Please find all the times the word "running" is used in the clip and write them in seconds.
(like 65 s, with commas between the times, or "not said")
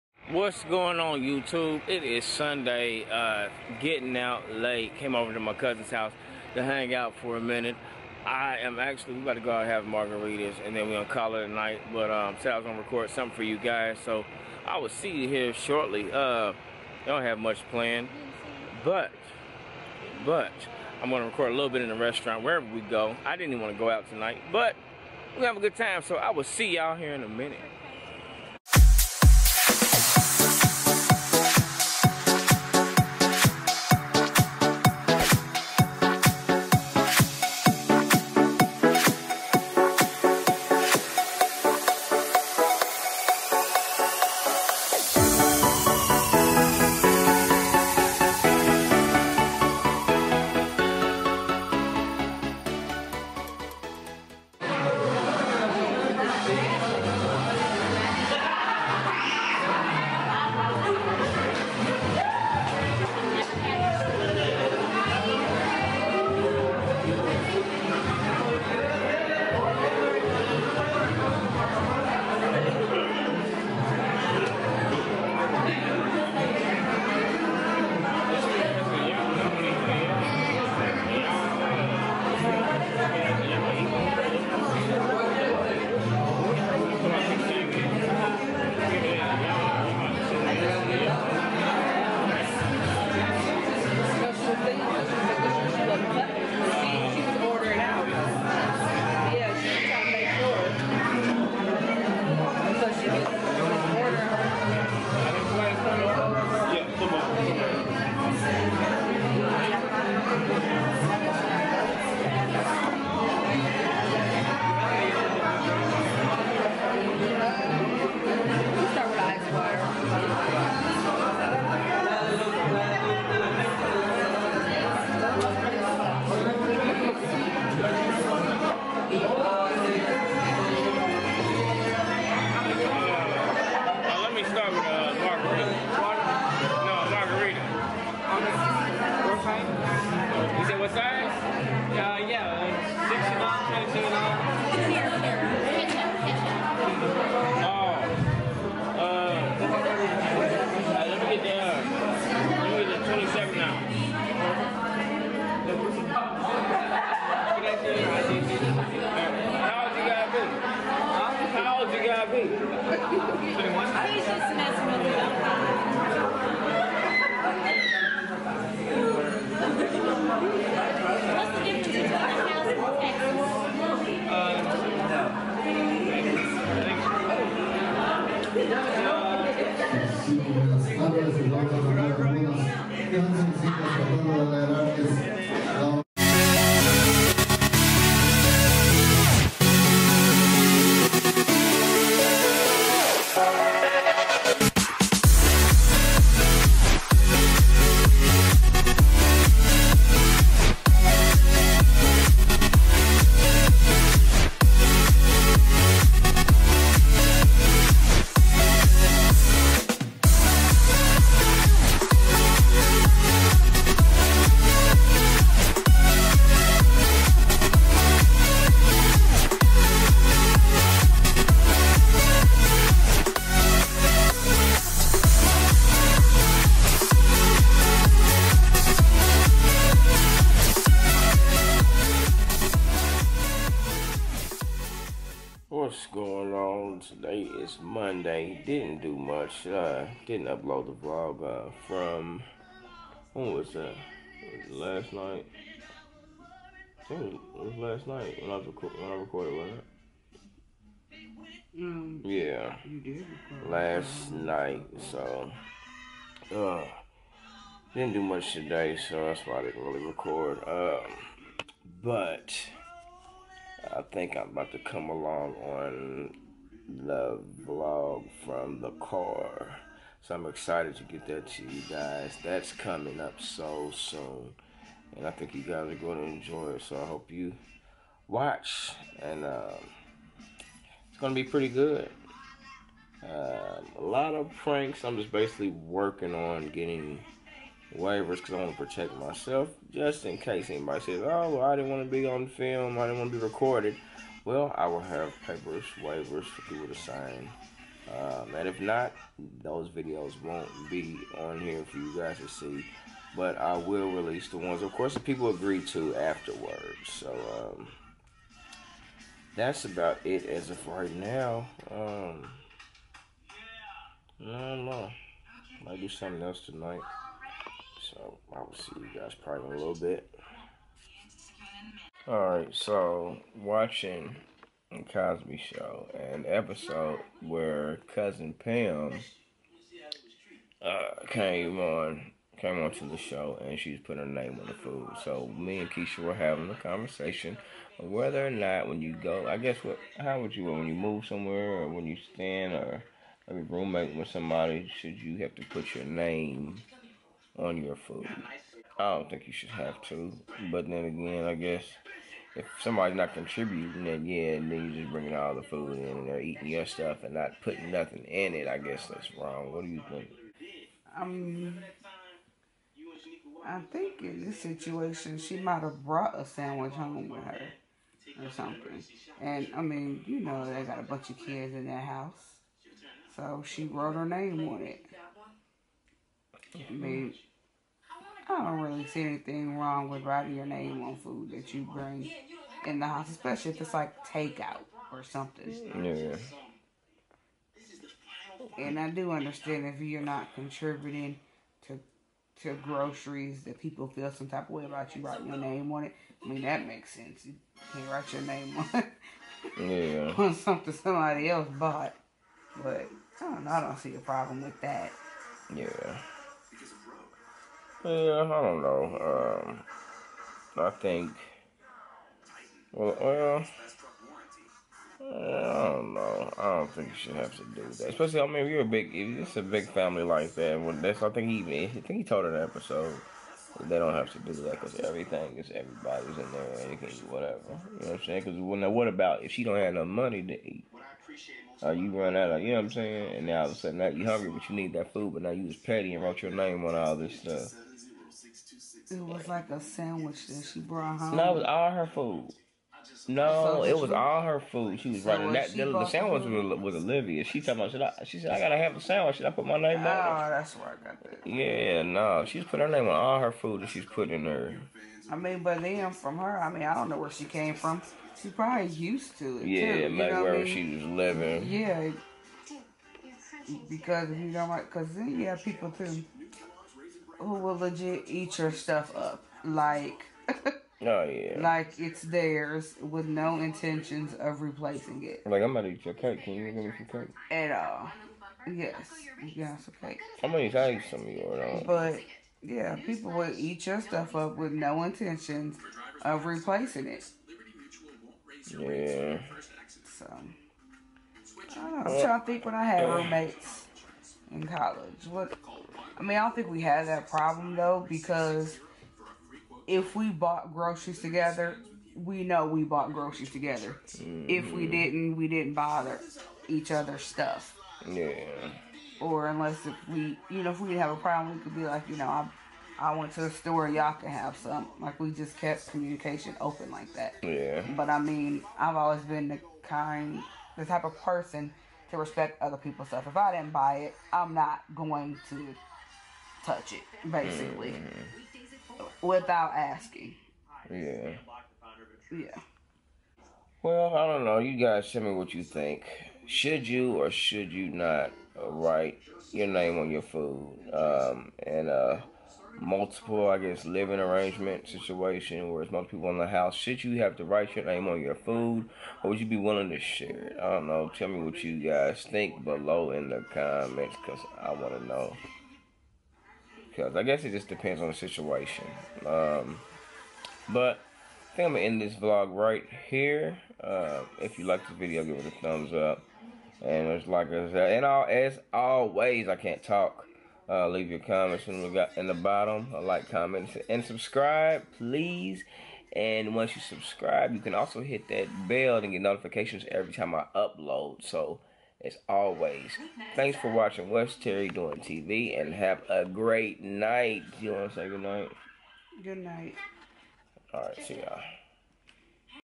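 445 s.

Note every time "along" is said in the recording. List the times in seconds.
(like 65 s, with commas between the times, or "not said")
265 s.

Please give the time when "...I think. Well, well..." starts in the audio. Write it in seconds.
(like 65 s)
410 s.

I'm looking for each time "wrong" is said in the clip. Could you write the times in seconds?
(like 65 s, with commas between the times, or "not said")
359 s, 379 s.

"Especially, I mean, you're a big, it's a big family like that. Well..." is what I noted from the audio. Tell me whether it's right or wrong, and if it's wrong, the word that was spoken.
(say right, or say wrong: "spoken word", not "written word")
right.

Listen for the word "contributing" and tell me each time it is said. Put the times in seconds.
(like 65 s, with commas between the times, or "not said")
353 s, 390 s.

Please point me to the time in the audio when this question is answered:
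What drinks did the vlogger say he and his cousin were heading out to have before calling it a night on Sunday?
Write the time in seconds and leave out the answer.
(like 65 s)
9 s.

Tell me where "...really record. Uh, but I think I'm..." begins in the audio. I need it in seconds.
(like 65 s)
259 s.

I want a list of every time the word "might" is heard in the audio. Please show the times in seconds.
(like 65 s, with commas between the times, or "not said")
315 s, 365 s.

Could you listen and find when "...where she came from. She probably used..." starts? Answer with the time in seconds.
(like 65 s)
457 s.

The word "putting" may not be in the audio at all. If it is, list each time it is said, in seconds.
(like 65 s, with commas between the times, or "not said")
334 s, 357 s, 454 s.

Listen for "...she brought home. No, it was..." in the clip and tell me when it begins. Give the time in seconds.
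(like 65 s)
440 s.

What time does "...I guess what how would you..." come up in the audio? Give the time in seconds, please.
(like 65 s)
339 s.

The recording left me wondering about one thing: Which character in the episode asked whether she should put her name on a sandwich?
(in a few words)
Olivia.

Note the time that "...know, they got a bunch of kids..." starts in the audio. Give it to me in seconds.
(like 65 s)
370 s.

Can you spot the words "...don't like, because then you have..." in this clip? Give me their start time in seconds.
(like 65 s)
464 s.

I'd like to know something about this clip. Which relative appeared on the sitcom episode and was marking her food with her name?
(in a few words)
Cousin Pam.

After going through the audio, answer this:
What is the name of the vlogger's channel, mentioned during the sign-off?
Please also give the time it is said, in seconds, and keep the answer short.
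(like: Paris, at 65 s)
What's Terry Doing TV, at 584 s.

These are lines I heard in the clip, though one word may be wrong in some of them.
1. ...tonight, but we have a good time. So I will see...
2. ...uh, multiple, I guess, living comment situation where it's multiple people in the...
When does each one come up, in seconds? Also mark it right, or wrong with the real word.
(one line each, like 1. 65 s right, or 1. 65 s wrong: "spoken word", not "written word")
1. 24 s right
2. 541 s wrong: "arrangement", not "comment".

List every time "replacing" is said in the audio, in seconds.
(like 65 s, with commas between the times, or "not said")
474 s, 486 s.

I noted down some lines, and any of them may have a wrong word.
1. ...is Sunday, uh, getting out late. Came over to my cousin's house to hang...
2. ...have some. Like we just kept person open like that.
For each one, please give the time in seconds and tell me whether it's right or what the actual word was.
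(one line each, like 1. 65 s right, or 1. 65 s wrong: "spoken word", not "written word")
1. 2 s right
2. 514 s wrong: "communication", not "person".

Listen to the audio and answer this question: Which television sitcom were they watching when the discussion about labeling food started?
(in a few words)
The Cosby Show.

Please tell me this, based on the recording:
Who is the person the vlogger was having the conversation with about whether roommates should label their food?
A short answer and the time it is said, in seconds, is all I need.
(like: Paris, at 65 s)
Keisha, at 335 s.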